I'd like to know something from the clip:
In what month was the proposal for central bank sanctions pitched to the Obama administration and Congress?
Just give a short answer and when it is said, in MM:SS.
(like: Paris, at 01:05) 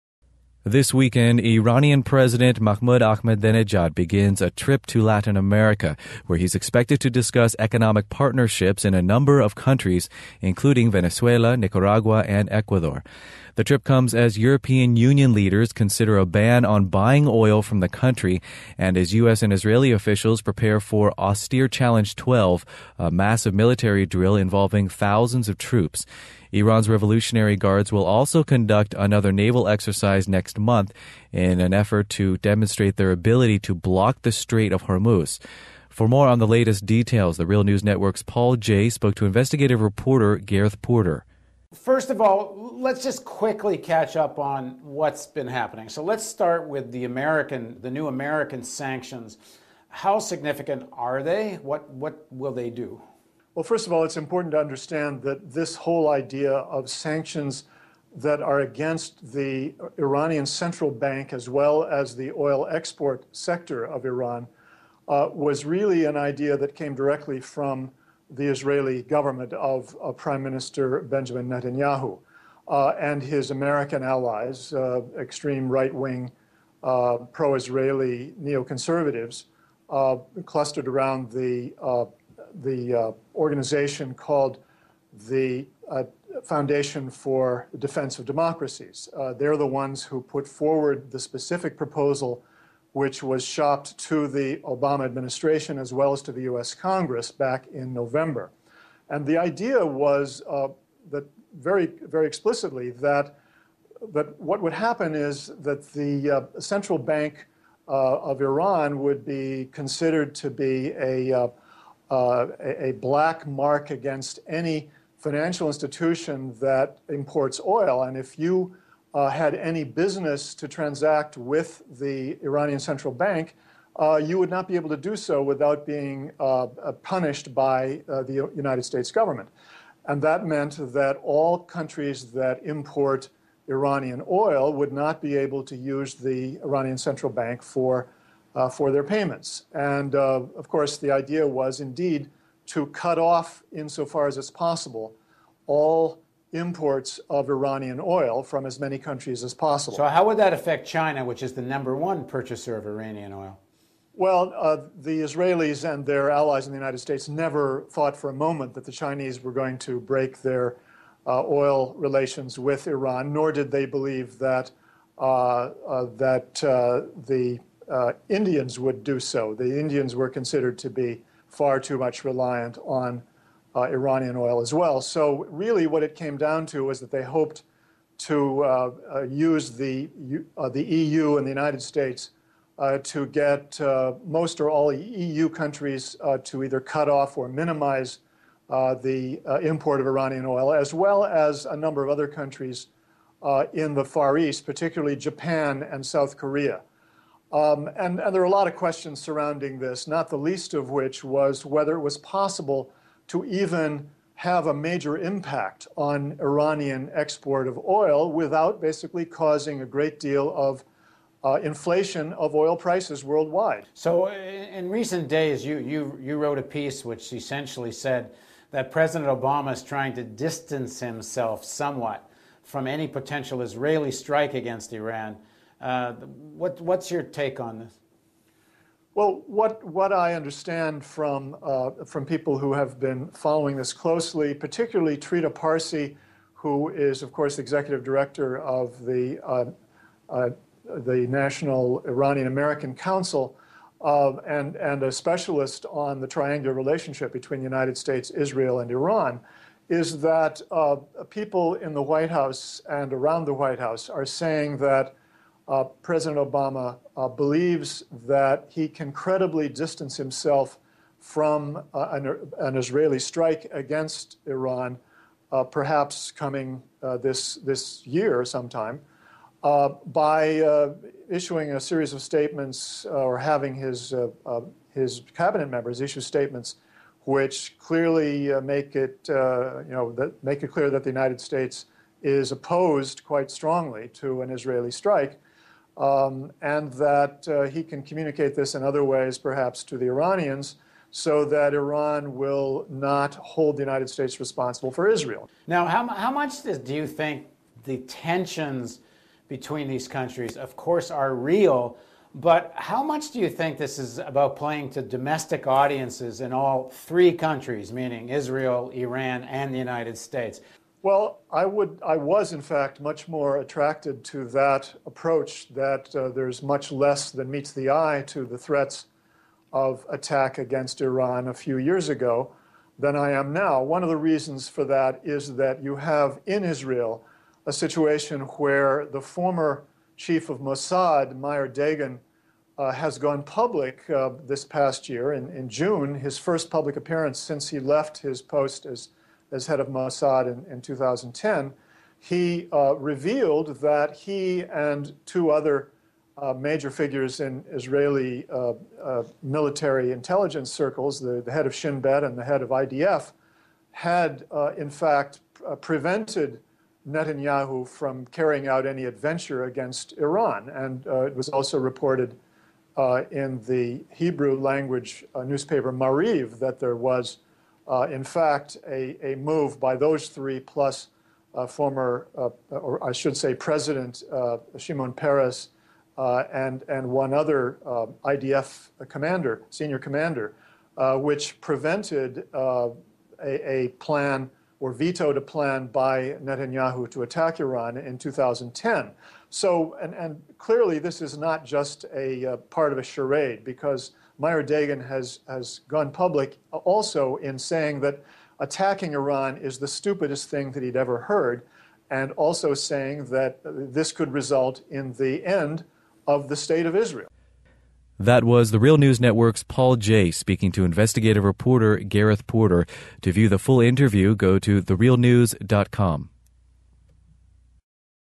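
November, at 01:37.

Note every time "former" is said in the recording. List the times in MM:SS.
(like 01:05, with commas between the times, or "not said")
05:29, 06:11.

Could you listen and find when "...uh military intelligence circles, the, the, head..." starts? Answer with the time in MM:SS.
05:49.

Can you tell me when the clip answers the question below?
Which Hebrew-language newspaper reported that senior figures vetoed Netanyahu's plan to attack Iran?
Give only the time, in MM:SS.
06:05.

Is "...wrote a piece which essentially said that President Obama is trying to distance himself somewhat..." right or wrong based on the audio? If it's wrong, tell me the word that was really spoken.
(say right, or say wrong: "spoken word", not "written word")
right.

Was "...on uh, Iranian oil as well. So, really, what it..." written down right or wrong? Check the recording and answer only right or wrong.
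right.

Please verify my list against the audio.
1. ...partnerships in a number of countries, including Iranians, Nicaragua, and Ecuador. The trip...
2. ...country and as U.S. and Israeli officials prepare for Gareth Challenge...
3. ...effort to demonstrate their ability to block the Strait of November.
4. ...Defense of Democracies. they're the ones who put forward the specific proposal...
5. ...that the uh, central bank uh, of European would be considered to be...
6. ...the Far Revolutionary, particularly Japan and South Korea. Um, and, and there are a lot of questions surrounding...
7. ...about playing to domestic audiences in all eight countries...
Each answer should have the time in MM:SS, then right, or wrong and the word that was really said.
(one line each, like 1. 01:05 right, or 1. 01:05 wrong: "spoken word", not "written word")
1. 00:08 wrong: "Venezuela", not "Iranians"
2. 00:17 wrong: "Austere", not "Gareth"
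3. 00:31 wrong: "Hormuz", not "November"
4. 01:27 right
5. 01:45 wrong: "Iran", not "European"
6. 03:13 wrong: "East", not "Revolutionary"
7. 05:04 wrong: "three", not "eight".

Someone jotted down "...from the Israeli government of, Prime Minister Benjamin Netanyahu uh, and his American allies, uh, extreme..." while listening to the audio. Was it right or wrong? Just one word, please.
right.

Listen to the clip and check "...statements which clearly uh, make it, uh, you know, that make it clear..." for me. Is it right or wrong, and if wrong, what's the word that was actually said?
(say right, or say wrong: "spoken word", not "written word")
right.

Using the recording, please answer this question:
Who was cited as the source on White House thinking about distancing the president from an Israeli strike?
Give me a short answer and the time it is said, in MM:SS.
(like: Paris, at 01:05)
Trita Parsi, at 03:55.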